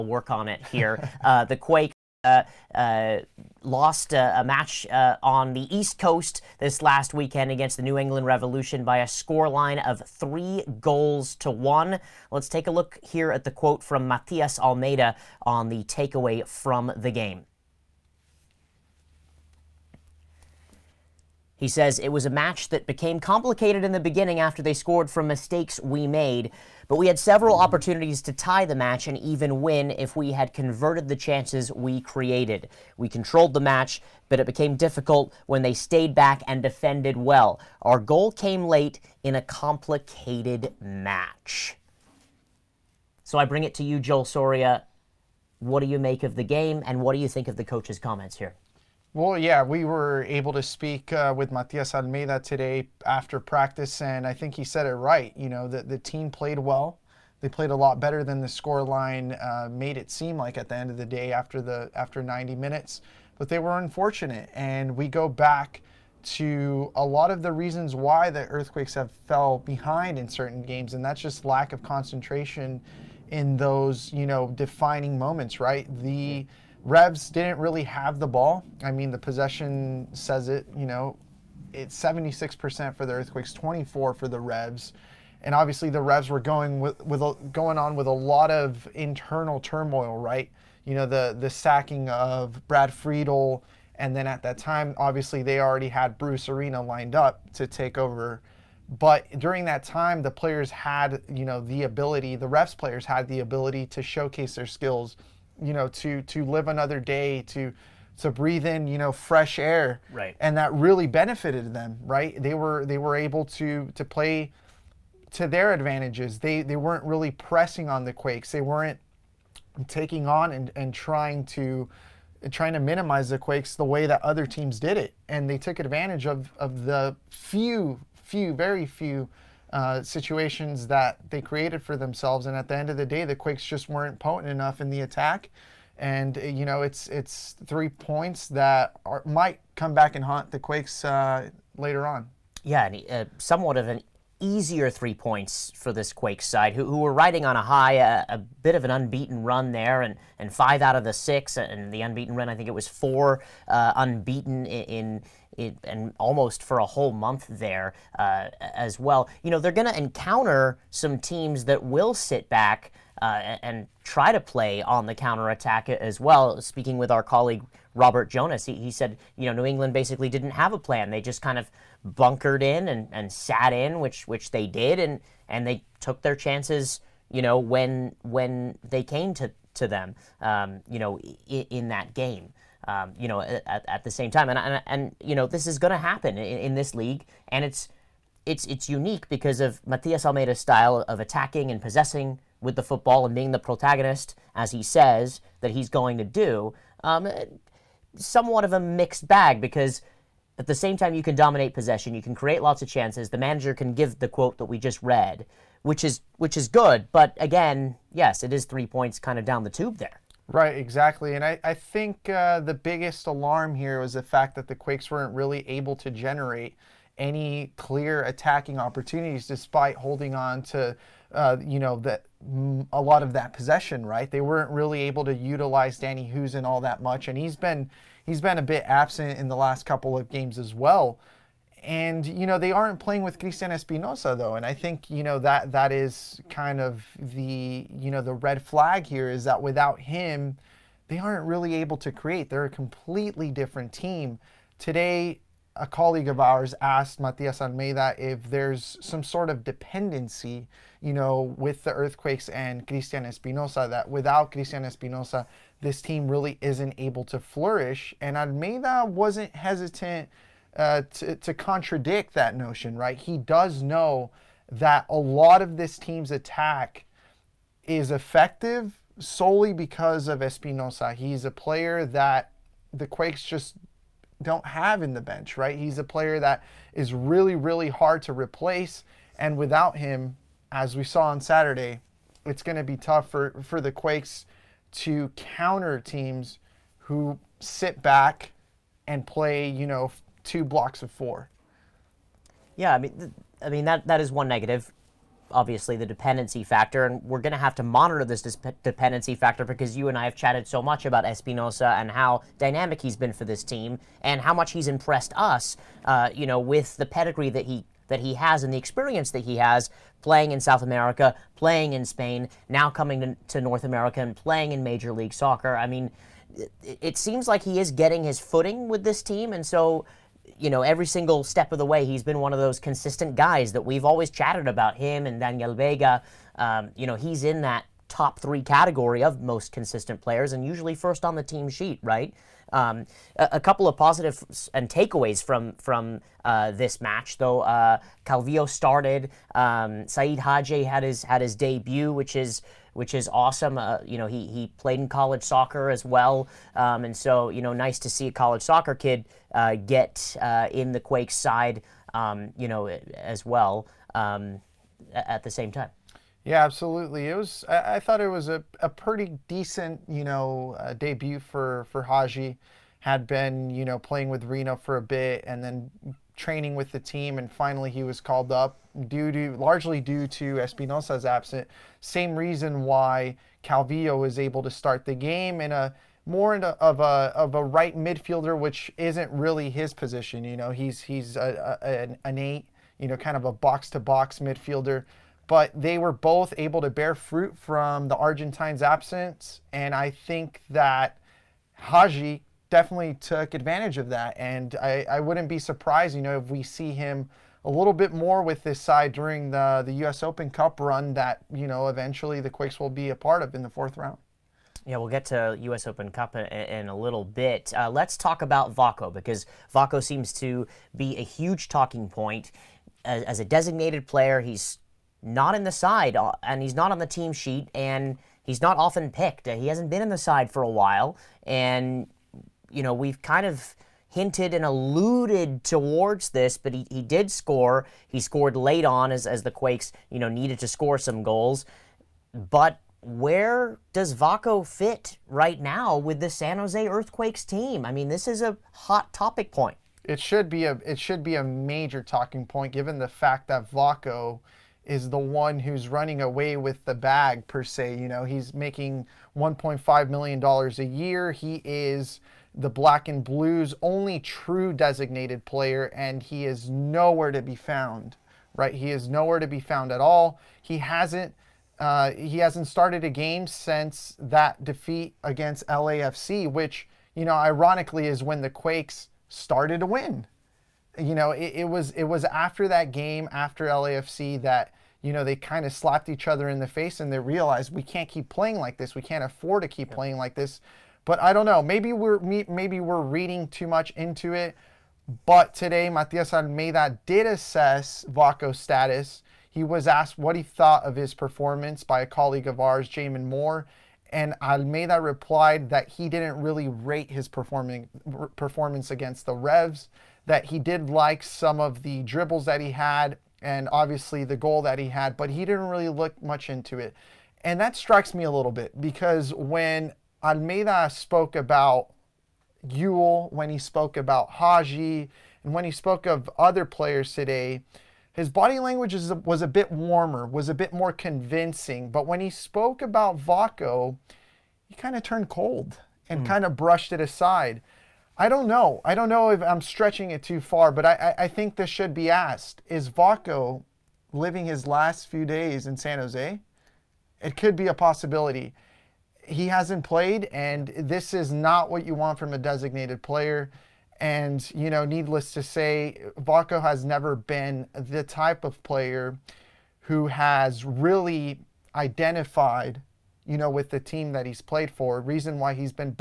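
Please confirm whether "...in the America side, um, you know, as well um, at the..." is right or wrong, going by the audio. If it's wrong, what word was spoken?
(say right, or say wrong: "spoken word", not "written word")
wrong: "Quakes", not "America".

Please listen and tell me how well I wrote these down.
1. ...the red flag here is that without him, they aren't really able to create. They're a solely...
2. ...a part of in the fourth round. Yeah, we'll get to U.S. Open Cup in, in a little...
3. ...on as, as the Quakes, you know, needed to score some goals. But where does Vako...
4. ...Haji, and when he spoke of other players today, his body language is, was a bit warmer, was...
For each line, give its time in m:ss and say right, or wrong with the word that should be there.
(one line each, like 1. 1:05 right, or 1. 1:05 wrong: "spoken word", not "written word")
1. 3:58 wrong: "completely", not "solely"
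2. 6:43 right
3. 7:08 right
4. 8:34 right.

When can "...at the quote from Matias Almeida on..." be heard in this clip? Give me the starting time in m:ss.
0:13.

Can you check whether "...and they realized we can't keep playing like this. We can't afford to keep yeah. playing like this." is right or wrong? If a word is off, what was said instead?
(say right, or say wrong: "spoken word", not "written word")
right.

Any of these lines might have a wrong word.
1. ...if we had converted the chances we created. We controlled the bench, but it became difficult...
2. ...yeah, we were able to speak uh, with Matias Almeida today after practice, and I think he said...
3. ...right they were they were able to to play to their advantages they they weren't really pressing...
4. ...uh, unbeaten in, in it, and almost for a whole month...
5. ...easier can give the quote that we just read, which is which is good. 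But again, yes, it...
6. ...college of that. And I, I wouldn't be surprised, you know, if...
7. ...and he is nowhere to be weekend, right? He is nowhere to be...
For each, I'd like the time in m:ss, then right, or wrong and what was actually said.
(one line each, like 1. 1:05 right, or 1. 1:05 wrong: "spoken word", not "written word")
1. 0:29 wrong: "match", not "bench"
2. 0:49 right
3. 1:52 right
4. 2:33 right
5. 3:23 wrong: "manager", not "easier"
6. 6:33 wrong: "advantage", not "college"
7. 7:35 wrong: "found", not "weekend".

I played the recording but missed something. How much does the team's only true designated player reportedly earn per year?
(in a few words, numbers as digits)
1.5 million dollars.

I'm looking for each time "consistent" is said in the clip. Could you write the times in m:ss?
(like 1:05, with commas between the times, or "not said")
5:22, 5:29.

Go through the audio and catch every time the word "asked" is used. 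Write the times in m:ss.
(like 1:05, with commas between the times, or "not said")
4:06, 8:09, 8:52.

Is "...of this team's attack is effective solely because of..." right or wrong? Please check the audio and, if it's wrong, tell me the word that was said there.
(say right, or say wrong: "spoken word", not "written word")
right.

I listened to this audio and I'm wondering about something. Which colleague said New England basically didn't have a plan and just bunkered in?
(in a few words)
Robert Jonas.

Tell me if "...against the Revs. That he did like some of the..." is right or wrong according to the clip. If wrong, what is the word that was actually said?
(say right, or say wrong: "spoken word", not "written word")
right.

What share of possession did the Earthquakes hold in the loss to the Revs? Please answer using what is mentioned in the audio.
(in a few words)
76%.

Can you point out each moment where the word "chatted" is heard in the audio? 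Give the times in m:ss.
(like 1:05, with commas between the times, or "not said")
5:00, 5:24.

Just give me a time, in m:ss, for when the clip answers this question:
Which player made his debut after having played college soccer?
5:40.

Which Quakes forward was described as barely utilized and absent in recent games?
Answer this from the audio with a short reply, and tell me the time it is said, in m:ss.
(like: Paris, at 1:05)
Danny Hoesen, at 3:45.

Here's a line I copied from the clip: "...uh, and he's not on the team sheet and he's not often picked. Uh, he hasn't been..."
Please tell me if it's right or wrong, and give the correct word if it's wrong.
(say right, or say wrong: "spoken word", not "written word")
right.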